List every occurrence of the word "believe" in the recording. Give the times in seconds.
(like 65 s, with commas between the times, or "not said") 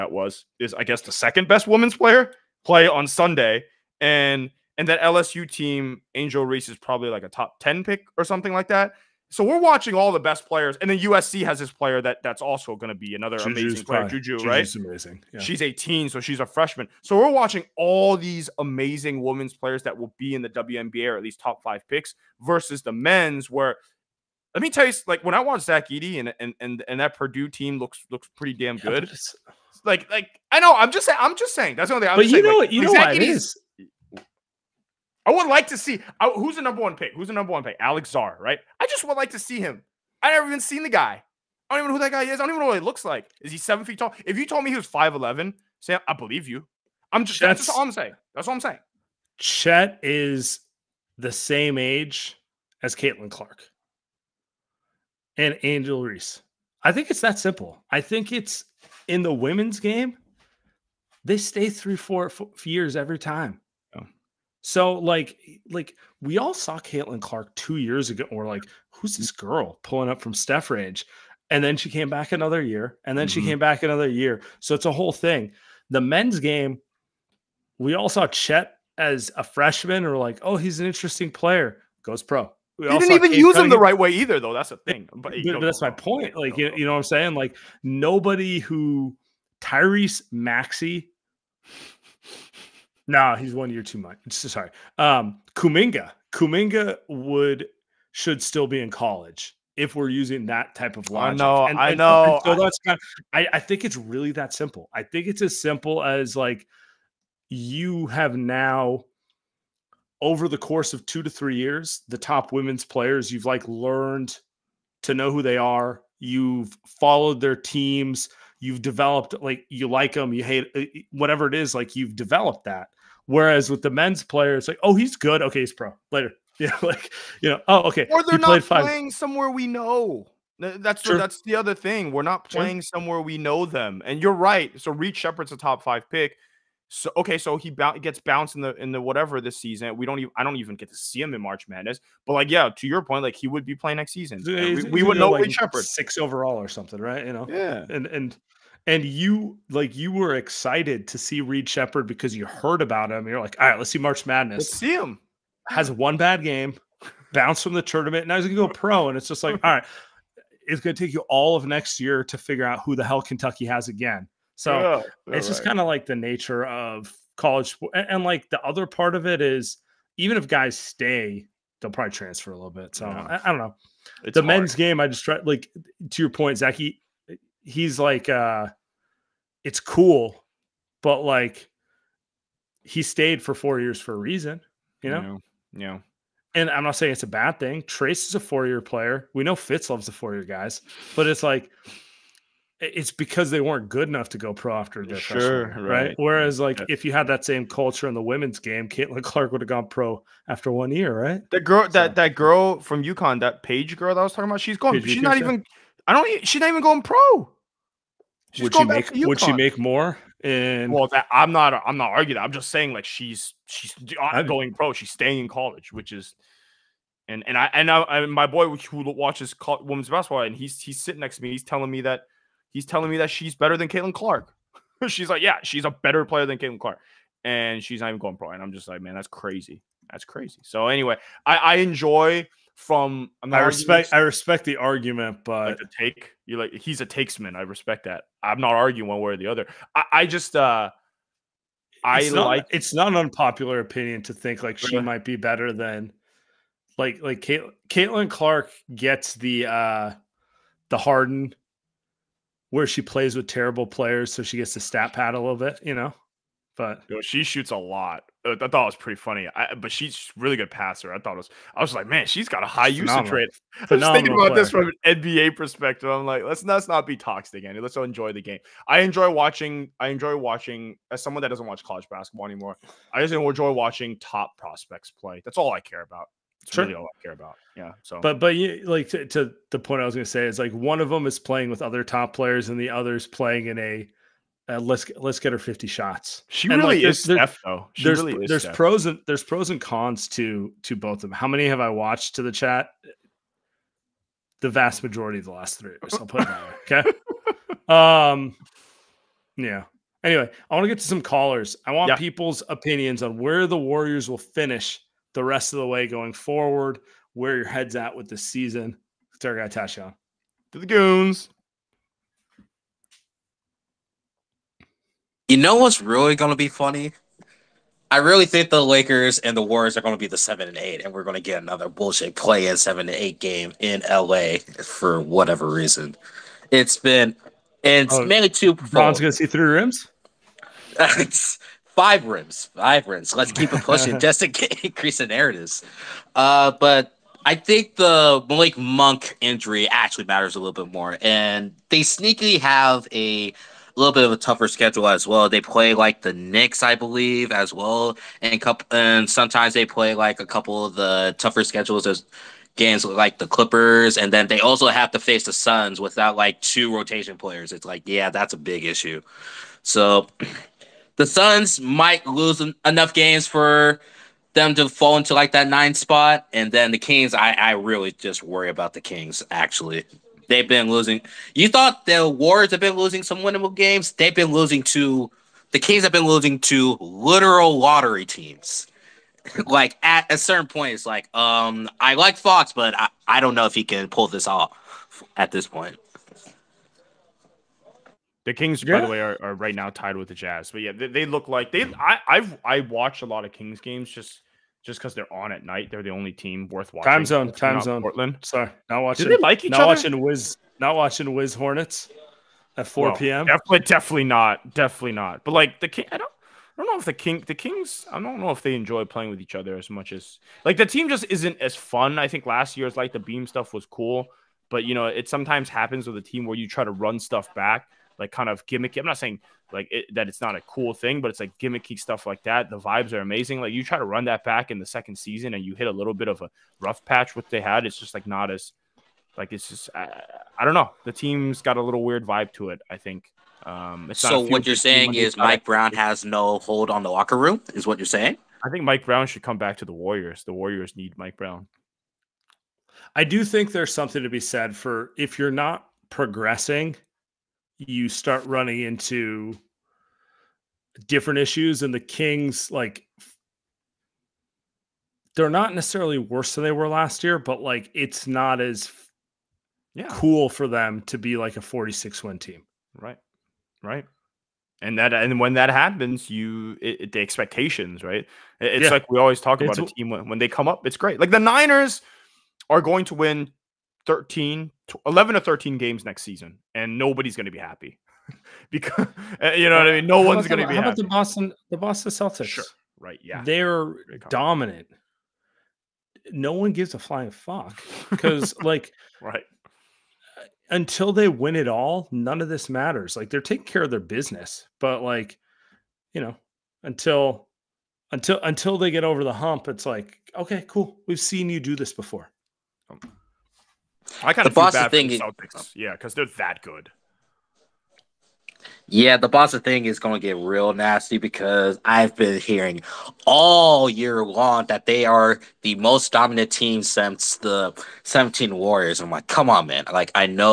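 46 s, 346 s.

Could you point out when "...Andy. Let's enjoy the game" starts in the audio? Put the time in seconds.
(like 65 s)
267 s.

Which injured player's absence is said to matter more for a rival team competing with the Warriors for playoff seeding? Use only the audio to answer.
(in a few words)
Malik Monk.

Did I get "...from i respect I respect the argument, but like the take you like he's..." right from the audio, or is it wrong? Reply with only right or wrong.
right.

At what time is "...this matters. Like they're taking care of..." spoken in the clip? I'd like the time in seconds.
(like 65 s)
492 s.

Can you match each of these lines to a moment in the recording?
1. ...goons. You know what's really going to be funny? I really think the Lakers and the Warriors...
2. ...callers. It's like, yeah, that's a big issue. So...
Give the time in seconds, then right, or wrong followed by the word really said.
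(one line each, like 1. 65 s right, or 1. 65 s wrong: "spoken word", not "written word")
1. 310 s right
2. 357 s wrong: "players", not "callers".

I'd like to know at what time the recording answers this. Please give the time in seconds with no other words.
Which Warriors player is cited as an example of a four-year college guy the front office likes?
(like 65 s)
187 s.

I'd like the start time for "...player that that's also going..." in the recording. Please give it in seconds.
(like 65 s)
11 s.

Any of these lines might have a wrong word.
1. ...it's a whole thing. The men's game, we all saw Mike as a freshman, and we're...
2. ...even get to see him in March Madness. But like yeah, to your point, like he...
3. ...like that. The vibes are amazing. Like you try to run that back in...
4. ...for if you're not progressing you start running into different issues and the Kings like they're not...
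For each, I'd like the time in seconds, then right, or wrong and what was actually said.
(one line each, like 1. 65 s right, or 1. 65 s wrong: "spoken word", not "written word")
1. 74 s wrong: "Chet", not "Mike"
2. 140 s right
3. 422 s right
4. 444 s right.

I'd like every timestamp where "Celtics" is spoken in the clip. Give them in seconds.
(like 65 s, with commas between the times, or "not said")
482 s, 505 s.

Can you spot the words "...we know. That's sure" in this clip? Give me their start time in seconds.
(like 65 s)
129 s.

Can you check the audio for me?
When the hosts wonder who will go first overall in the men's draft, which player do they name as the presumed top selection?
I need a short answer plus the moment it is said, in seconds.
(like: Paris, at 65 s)
Alex Sarr, at 37 s.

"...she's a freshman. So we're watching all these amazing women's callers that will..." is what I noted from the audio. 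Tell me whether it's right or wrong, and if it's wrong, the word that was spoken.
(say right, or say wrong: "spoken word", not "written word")
wrong: "players", not "callers".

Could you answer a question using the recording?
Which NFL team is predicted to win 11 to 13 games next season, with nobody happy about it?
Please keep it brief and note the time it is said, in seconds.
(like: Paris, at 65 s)
Niners, at 471 s.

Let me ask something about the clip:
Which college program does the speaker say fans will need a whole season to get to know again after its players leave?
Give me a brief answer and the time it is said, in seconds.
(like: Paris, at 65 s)
Kentucky, at 163 s.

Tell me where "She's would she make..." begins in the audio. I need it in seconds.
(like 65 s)
208 s.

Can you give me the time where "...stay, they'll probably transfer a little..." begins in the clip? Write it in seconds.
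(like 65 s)
170 s.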